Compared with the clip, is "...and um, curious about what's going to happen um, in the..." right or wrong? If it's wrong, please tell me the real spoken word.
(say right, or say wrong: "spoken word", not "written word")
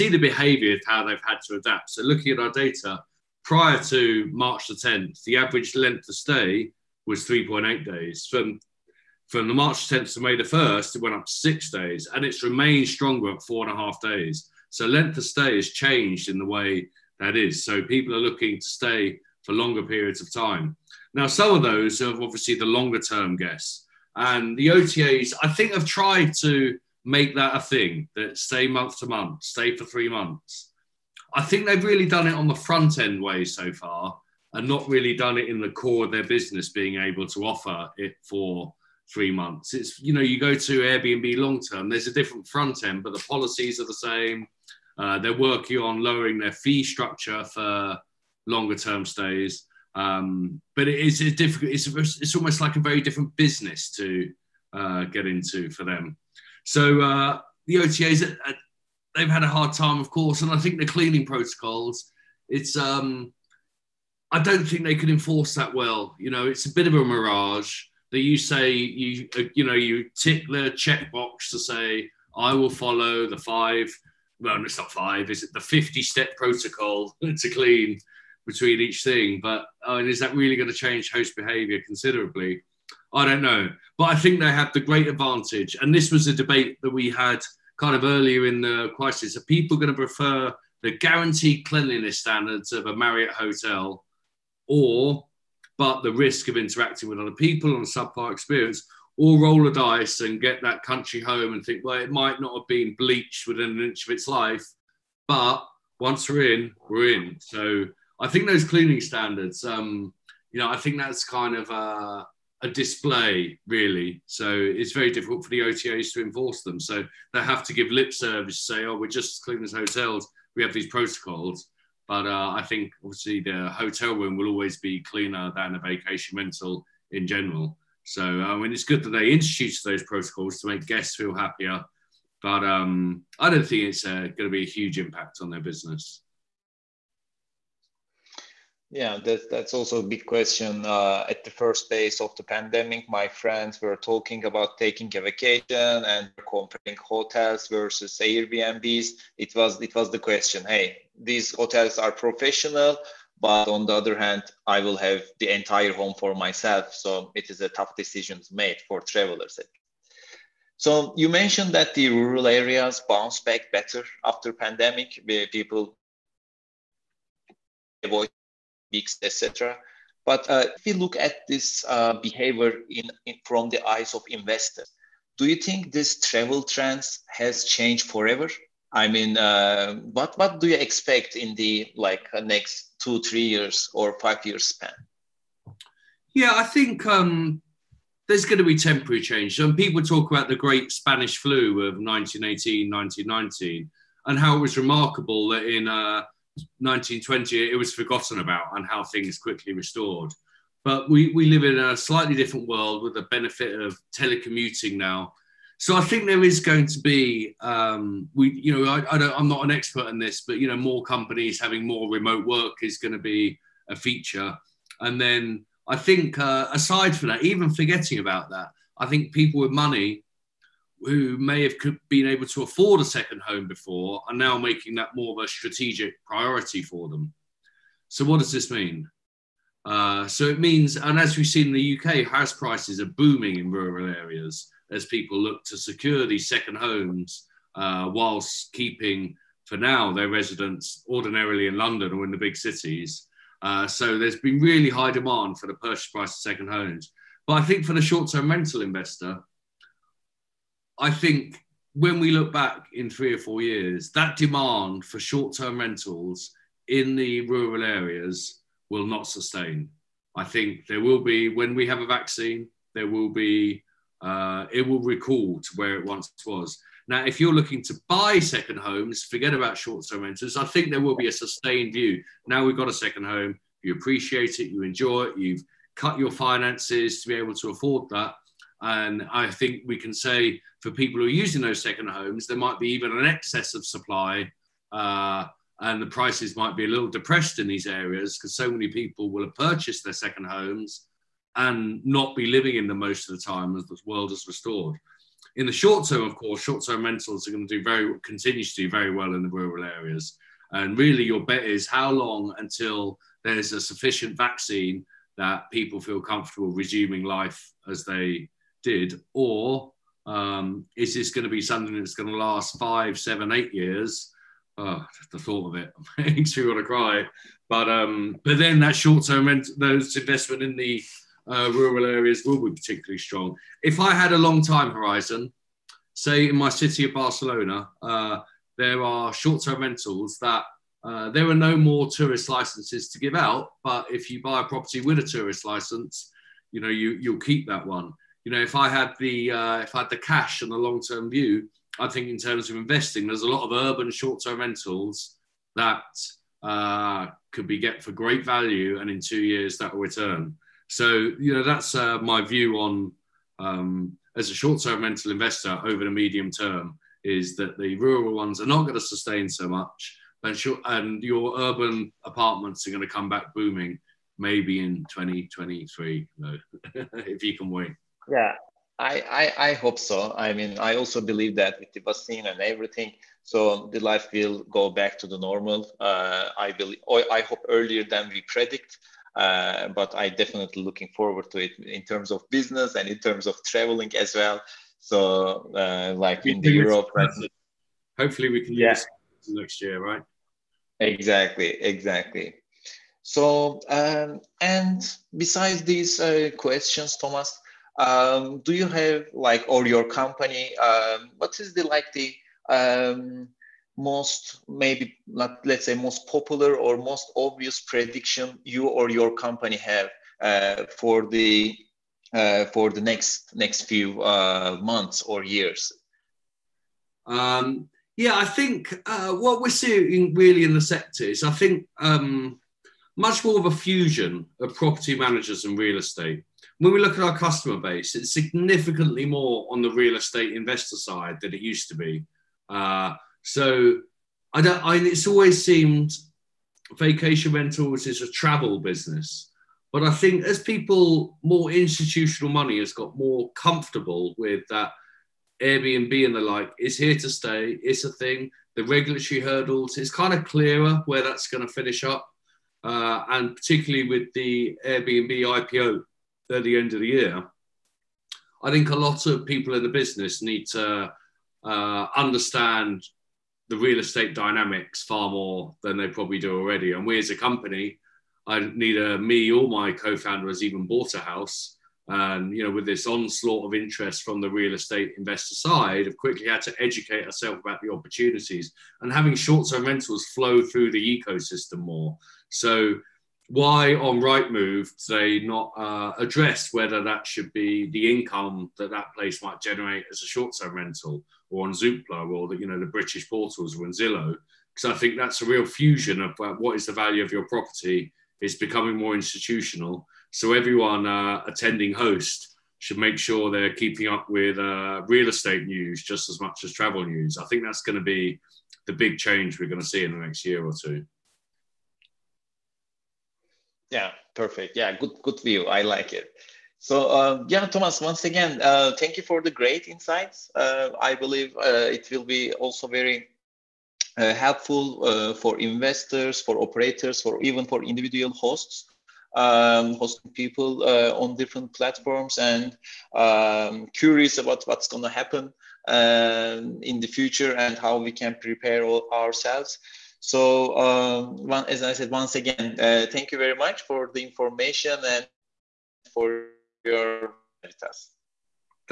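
right.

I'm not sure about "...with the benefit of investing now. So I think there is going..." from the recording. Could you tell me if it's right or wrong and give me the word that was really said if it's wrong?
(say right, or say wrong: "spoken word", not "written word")
wrong: "telecommuting", not "investing".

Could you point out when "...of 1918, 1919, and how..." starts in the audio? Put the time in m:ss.
3:11.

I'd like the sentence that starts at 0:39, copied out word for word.
It's you know you go to Airbnb long term.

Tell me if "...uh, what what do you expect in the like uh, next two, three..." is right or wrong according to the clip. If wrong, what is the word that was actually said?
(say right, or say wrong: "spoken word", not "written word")
right.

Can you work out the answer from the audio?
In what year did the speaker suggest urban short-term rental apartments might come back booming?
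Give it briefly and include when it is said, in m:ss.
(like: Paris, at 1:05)
2023, at 6:05.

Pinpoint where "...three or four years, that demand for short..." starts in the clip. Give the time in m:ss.
4:13.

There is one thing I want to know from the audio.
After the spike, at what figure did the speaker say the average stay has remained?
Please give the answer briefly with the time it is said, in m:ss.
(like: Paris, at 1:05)
4.5 days, at 0:13.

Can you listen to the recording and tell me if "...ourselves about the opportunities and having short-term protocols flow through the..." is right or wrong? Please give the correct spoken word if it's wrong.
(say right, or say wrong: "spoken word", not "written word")
wrong: "rentals", not "protocols".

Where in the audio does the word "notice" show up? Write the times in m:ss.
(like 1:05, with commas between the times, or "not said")
not said.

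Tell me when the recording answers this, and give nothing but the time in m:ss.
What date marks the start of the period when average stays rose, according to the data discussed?
0:04.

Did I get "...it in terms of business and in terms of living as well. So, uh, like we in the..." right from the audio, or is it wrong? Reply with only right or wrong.
wrong.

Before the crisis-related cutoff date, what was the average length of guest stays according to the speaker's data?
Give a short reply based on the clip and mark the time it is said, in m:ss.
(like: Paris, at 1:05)
3.8 days, at 0:07.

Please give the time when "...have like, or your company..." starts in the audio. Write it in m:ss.
6:38.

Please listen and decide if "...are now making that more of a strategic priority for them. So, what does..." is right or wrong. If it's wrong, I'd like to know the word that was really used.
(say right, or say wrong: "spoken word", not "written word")
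right.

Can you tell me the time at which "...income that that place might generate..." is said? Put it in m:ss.
8:08.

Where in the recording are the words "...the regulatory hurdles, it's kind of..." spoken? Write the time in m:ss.
7:28.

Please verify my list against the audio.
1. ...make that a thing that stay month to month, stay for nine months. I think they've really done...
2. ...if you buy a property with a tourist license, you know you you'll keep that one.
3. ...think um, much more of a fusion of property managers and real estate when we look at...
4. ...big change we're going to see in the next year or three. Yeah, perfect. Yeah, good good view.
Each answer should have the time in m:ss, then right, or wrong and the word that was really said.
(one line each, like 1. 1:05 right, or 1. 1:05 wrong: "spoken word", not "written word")
1. 0:27 wrong: "three", not "nine"
2. 5:34 right
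3. 7:01 right
4. 8:28 wrong: "two", not "three".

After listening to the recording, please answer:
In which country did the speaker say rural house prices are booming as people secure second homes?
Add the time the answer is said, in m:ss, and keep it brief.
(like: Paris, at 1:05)
UK, at 3:52.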